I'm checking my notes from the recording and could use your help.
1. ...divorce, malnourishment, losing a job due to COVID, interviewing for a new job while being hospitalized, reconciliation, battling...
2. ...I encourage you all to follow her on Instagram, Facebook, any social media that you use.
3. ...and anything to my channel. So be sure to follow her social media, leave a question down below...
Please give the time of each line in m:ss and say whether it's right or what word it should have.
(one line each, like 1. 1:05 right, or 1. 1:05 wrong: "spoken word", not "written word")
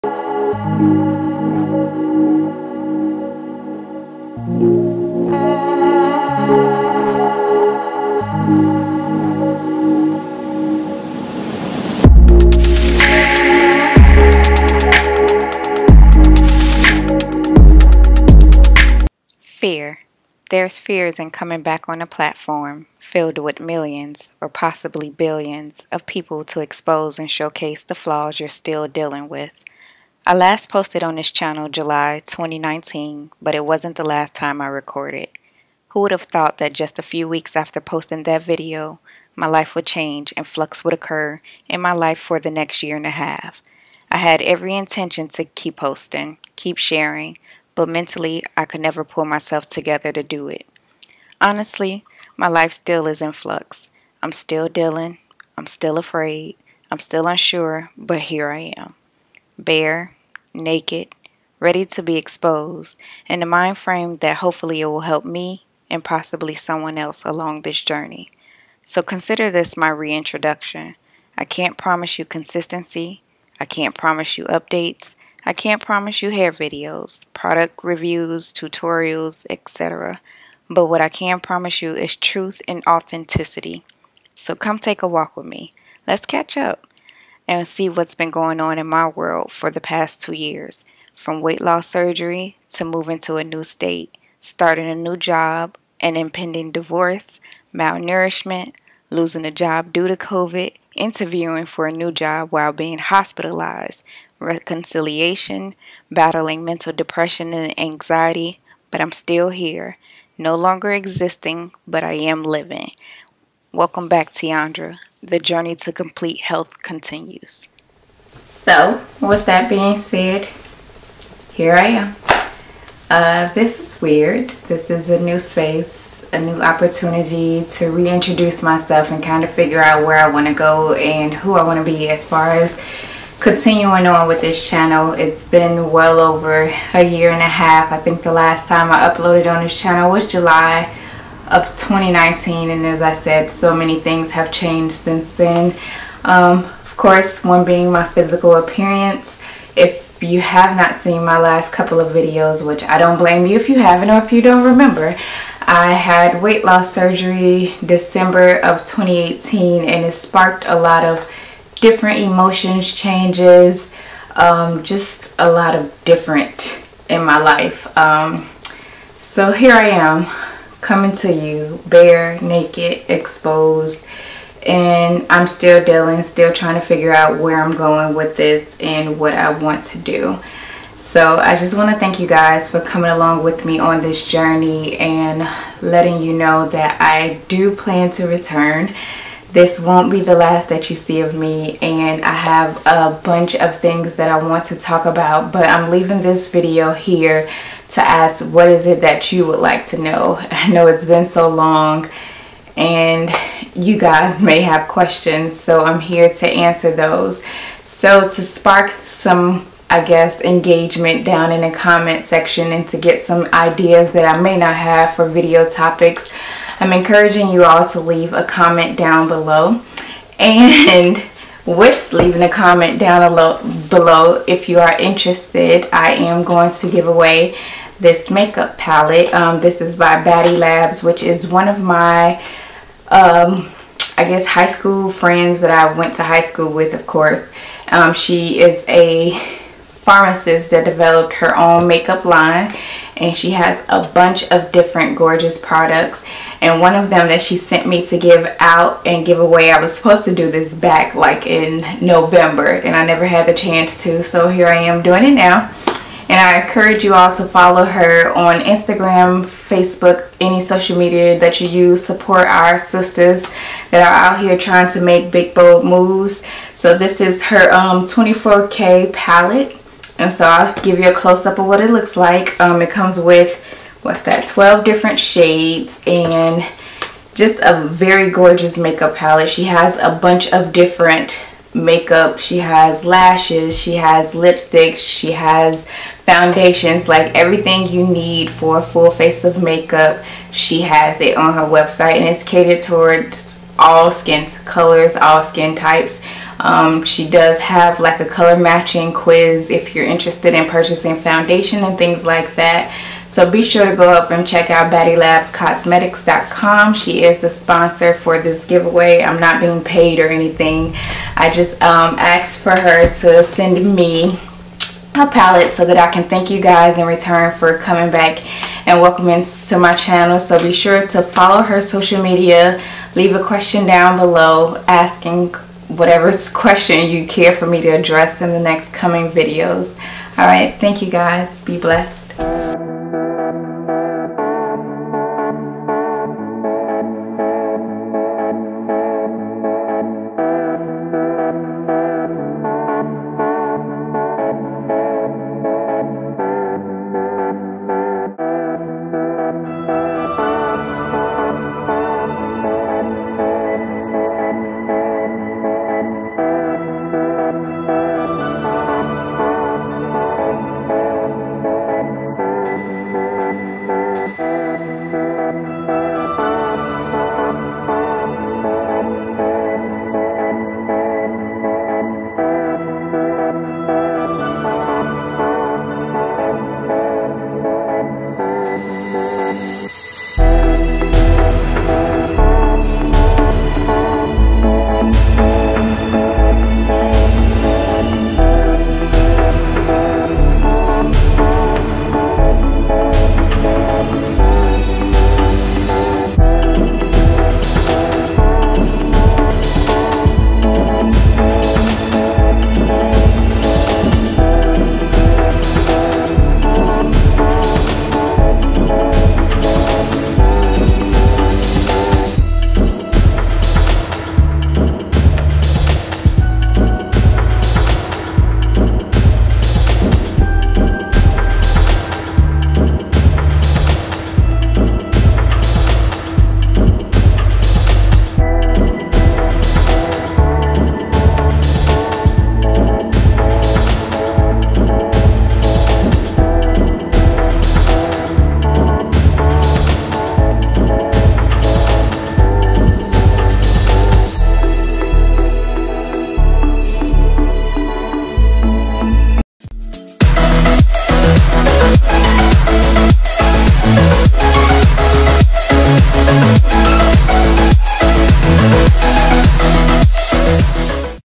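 1. 1:36 right
2. 4:16 right
3. 5:18 wrong: "welcoming", not "anything".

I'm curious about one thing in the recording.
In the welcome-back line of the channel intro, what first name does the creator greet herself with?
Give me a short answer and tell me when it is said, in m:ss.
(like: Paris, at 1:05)
Teaundra, at 1:54.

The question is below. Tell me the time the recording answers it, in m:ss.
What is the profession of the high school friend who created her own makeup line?
4:00.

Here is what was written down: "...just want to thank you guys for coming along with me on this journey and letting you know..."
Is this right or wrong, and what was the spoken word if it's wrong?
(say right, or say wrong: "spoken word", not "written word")
right.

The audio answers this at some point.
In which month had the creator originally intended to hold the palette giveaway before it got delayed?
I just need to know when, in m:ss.
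4:12.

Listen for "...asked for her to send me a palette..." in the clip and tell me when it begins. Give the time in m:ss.
5:12.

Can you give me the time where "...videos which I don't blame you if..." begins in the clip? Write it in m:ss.
2:32.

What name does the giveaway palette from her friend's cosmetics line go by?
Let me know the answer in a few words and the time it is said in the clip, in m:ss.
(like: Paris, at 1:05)
24K, at 4:28.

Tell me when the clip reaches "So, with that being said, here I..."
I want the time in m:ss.
1:58.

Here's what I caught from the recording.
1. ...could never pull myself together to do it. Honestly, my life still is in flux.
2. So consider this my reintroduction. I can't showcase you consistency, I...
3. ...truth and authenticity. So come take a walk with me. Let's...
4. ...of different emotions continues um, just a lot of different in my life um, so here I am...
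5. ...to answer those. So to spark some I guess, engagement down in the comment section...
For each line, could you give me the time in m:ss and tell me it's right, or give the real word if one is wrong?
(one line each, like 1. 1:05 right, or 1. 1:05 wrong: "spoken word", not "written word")
1. 0:48 right
2. 1:08 wrong: "promise", not "showcase"
3. 1:22 right
4. 2:41 wrong: "changes", not "continues"
5. 3:26 right.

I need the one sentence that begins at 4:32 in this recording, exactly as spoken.
Um, it comes with, what's that, 12 different shades and just a very gorgeous makeup palette.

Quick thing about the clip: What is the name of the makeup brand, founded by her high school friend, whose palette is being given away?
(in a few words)
Baddie Labs.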